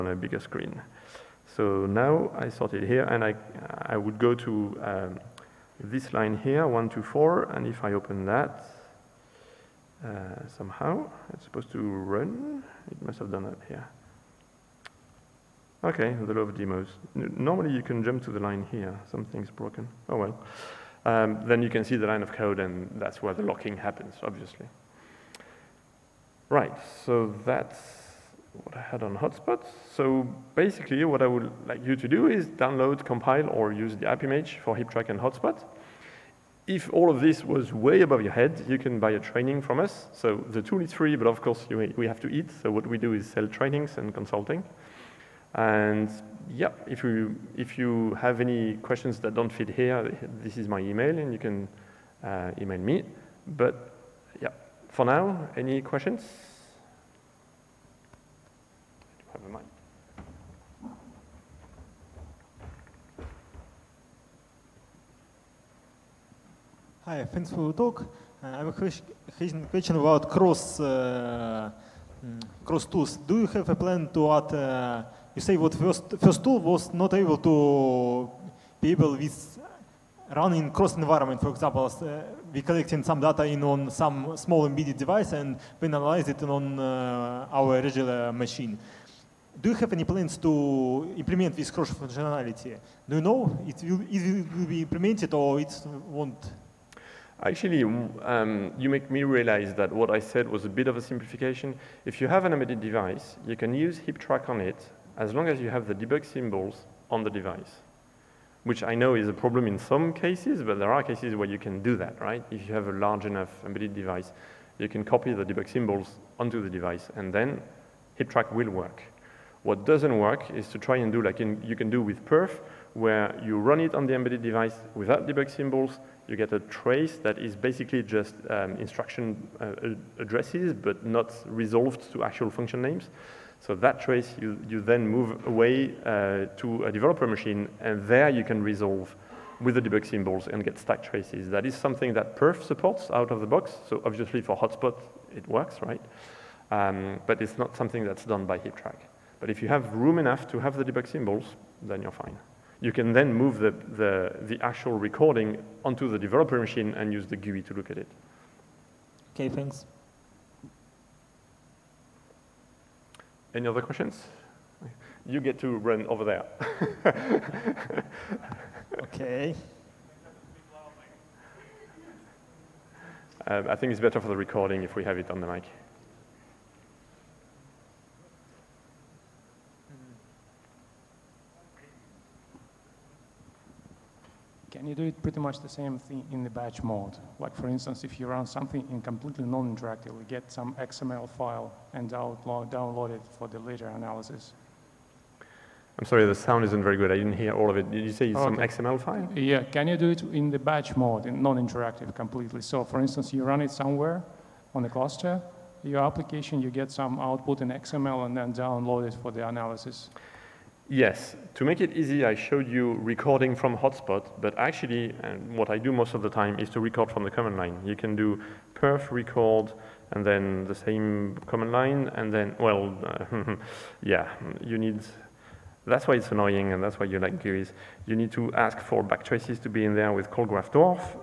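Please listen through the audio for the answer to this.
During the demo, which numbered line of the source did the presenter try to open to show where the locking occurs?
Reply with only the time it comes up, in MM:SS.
00:06.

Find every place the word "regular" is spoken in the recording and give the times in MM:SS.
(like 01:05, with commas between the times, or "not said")
01:27.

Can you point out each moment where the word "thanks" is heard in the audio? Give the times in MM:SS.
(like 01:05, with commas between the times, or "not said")
01:07, 02:39.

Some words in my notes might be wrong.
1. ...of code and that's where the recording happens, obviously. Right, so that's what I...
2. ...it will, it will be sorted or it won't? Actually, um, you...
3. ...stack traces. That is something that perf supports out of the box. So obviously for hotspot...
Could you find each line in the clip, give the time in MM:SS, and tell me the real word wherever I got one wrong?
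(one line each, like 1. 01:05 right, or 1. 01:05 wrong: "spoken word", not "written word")
1. 00:22 wrong: "locking", not "recording"
2. 01:33 wrong: "implemented", not "sorted"
3. 02:20 right.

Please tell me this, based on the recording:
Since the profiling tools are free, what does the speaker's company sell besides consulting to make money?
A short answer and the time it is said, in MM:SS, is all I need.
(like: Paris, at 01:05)
Trainings, at 00:43.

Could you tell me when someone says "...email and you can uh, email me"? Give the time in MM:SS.
00:50.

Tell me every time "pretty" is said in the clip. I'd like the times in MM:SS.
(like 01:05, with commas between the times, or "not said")
03:05.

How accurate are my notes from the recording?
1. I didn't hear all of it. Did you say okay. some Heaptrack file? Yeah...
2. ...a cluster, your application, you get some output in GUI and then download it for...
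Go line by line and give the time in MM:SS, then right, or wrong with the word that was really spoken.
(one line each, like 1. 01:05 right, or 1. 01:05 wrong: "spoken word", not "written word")
1. 03:17 wrong: "XML", not "Heaptrack"
2. 03:24 wrong: "XML", not "GUI".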